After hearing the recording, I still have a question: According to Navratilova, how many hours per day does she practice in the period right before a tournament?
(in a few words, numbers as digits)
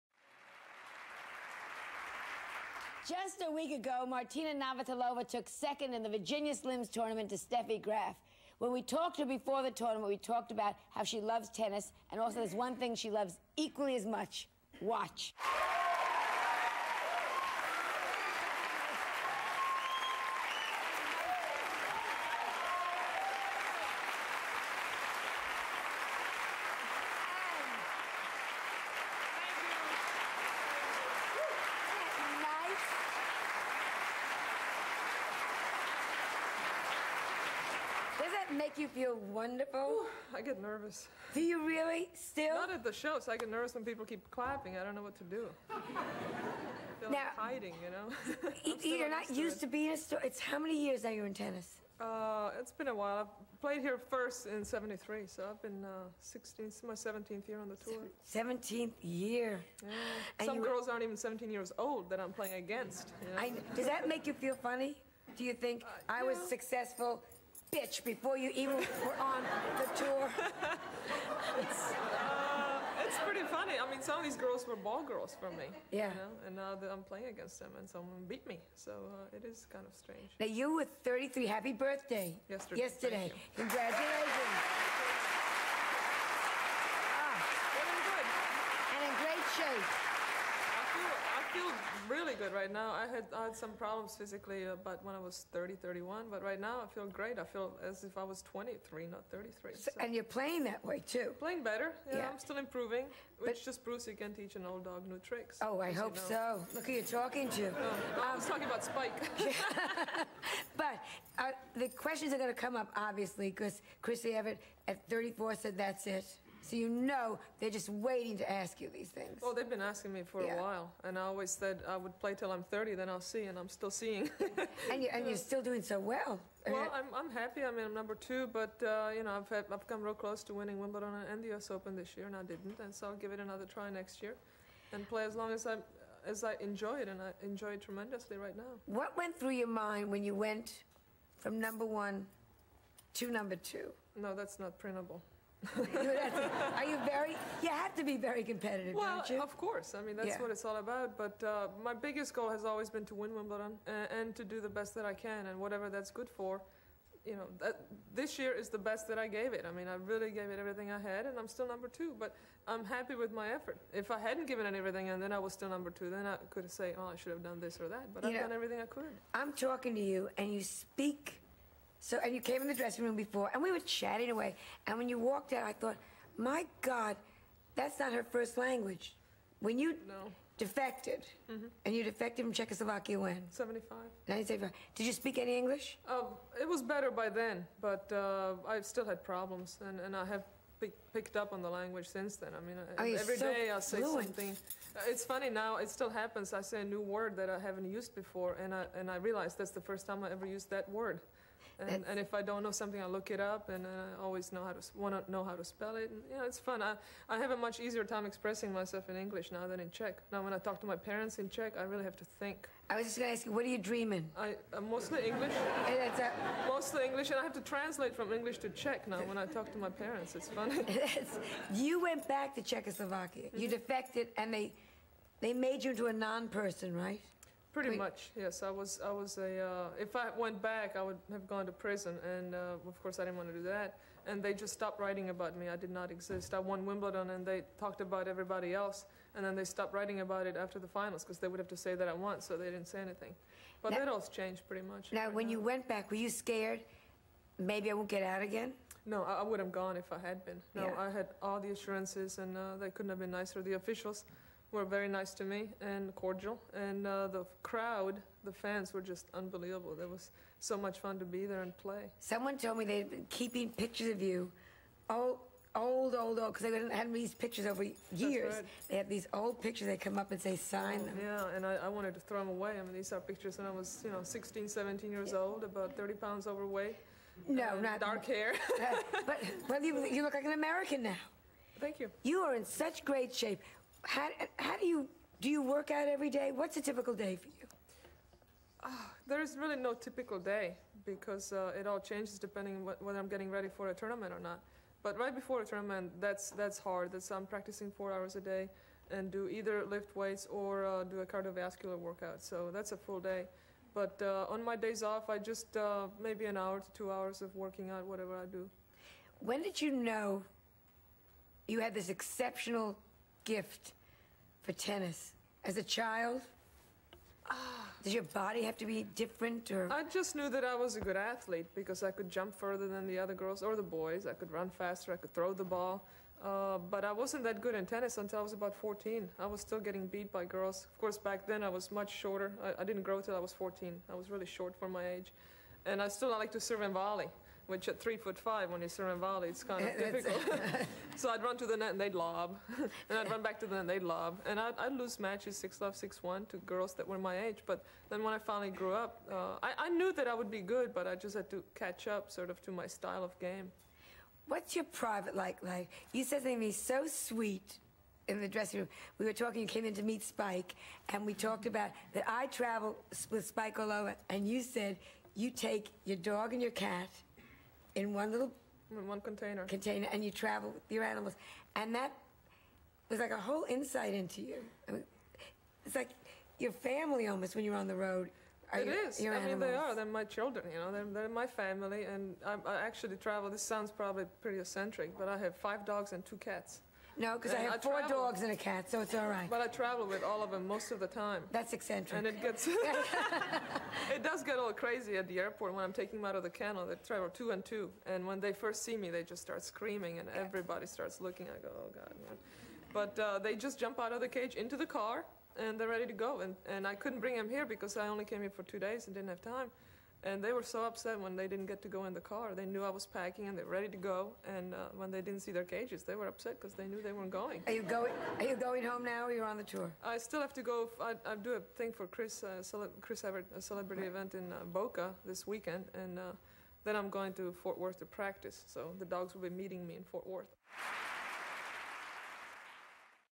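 4.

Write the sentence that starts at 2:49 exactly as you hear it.
I'm talking to you, and you speak so, and you came in the dressing room before, and we were chatting away.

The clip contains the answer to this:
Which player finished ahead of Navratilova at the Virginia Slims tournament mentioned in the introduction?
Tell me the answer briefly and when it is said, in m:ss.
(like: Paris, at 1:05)
Steffi Graf, at 0:07.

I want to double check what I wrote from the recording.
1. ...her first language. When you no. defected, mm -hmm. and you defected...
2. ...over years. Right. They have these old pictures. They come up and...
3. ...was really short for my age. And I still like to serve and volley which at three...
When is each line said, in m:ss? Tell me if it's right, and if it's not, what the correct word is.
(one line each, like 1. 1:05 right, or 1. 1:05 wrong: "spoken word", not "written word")
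1. 2:58 right
2. 4:27 right
3. 5:34 right.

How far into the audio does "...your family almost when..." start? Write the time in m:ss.
6:16.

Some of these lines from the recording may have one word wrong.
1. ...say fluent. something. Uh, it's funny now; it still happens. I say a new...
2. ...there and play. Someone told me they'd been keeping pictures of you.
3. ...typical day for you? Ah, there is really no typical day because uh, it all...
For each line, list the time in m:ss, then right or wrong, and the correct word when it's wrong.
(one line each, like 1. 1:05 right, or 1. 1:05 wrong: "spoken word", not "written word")
1. 3:13 right
2. 4:21 right
3. 4:46 right.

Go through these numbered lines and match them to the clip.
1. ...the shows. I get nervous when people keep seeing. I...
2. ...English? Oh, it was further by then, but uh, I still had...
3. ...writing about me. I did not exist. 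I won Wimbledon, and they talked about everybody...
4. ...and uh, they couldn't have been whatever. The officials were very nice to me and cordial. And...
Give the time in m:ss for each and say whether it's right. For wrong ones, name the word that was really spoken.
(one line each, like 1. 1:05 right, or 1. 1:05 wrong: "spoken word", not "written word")
1. 0:42 wrong: "clapping", not "seeing"
2. 3:05 wrong: "better", not "further"
3. 3:54 right
4. 4:12 wrong: "nicer", not "whatever".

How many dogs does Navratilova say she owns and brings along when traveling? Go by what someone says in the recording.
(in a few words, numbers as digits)
5.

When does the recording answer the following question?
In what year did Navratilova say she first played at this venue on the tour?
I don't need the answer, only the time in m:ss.
0:54.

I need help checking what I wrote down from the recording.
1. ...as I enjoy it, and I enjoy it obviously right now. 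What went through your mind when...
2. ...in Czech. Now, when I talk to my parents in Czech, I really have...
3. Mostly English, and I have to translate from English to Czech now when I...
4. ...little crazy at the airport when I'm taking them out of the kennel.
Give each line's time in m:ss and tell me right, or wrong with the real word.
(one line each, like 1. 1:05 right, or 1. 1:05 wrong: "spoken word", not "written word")
1. 2:16 wrong: "tremendously", not "obviously"
2. 3:29 right
3. 3:36 right
4. 6:34 right.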